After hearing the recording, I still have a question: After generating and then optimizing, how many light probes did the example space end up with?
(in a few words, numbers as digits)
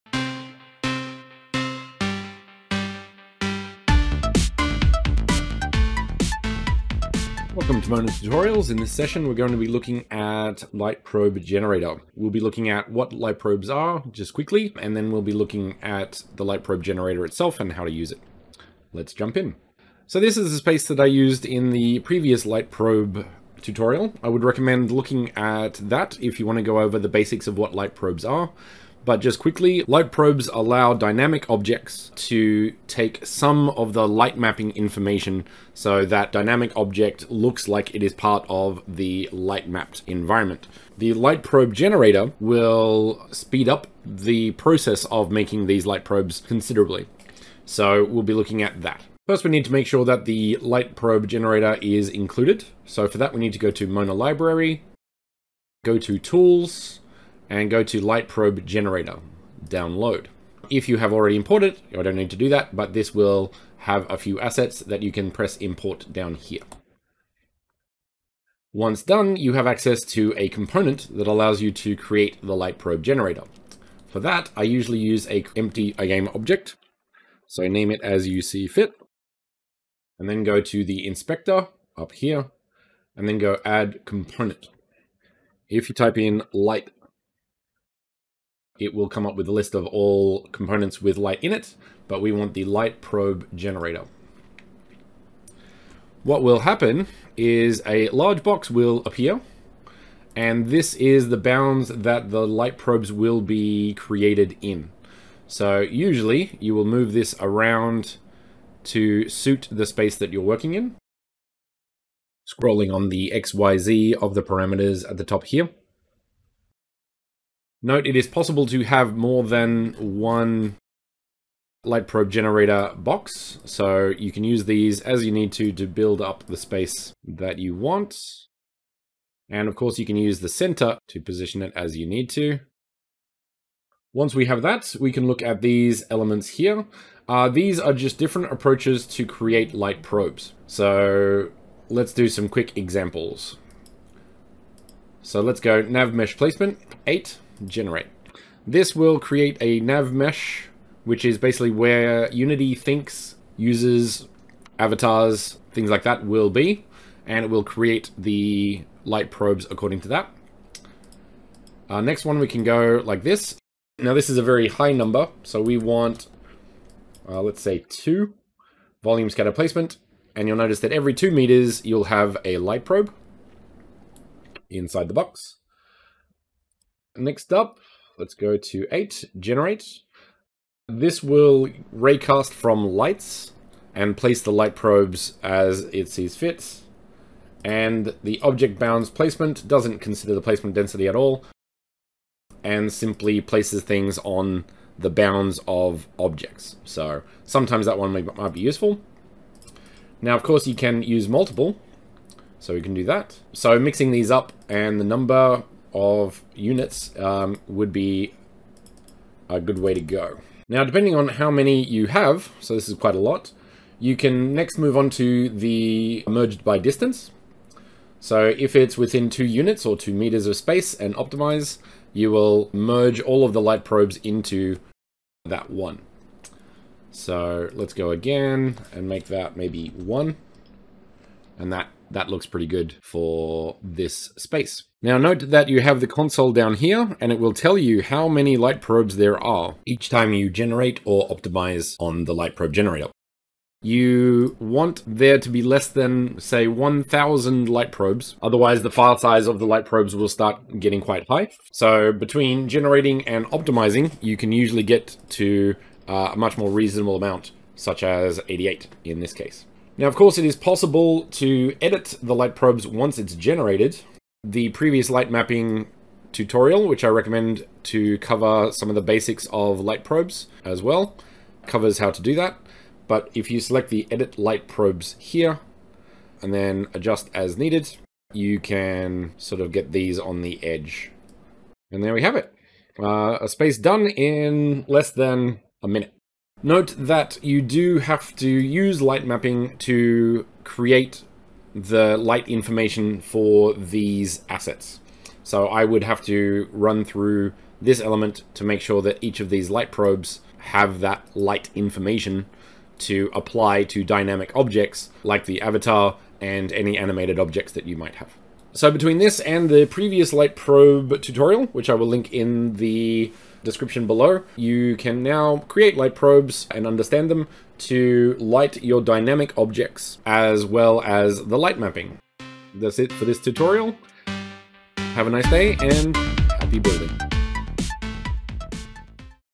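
88.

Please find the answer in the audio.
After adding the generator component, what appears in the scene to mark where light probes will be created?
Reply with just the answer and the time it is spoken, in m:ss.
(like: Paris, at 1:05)
A large box, at 1:37.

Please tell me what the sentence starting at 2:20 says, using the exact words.
So let's do some quick examples.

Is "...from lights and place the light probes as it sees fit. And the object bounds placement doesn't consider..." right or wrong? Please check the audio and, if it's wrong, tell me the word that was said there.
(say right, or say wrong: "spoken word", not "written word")
right.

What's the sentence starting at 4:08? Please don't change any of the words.
Otherwise, the file size of the light probes will start getting quite high.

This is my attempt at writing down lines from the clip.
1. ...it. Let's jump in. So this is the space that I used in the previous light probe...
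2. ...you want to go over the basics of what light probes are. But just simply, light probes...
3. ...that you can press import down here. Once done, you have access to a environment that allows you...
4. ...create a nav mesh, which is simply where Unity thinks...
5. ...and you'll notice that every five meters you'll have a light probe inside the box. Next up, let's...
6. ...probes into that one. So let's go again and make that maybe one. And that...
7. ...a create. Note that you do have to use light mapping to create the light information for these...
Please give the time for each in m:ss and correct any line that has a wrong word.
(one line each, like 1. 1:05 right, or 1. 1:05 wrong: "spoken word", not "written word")
1. 0:18 right
2. 0:26 wrong: "quickly", not "simply"
3. 1:04 wrong: "component", not "environment"
4. 2:29 wrong: "basically", not "simply"
5. 2:50 wrong: "two", not "five"
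6. 3:43 right
7. 4:45 wrong: "minute", not "create".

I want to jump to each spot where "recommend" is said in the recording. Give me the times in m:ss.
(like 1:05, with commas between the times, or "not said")
0:24, 4:27.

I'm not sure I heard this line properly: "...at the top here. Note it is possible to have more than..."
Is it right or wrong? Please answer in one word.
right.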